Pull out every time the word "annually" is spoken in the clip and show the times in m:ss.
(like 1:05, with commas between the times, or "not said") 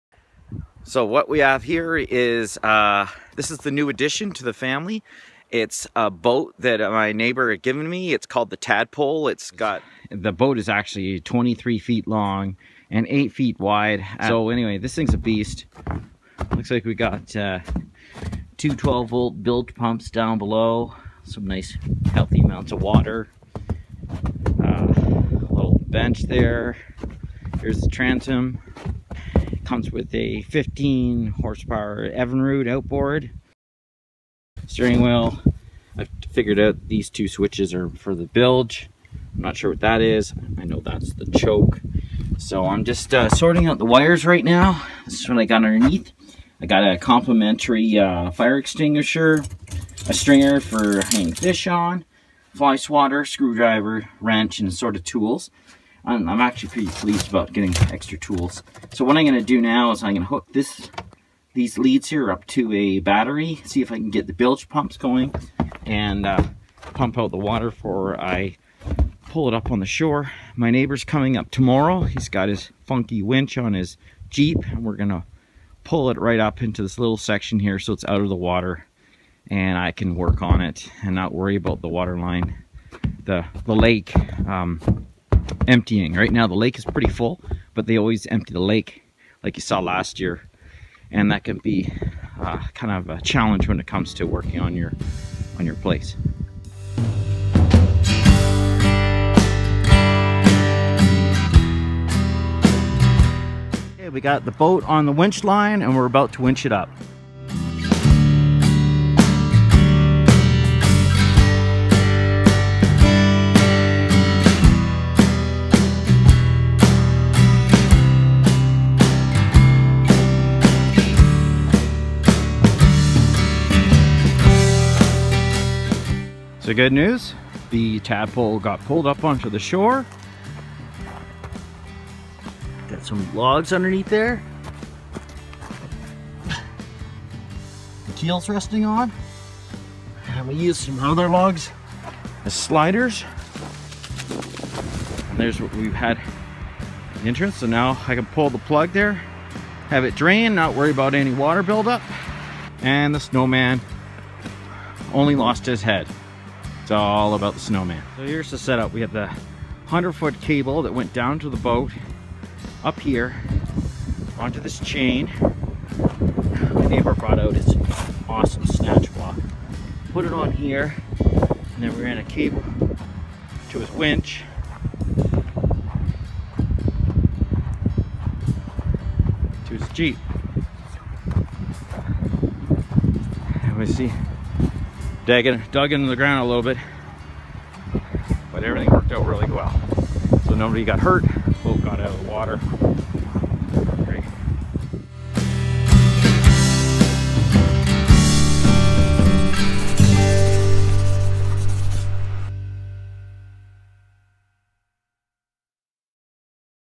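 not said.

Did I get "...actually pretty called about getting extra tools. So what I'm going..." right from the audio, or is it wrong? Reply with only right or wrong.
wrong.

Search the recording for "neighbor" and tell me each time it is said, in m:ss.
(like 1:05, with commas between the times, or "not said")
0:07, 1:10, 2:46.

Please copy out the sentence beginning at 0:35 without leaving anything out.
I figured out these two switches are for the bilge.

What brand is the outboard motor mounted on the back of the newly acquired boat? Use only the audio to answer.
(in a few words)
Evinrude.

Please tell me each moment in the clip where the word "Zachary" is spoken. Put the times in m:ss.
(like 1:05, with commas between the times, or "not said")
not said.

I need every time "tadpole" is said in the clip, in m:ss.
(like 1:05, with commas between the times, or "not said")
0:08, 2:07.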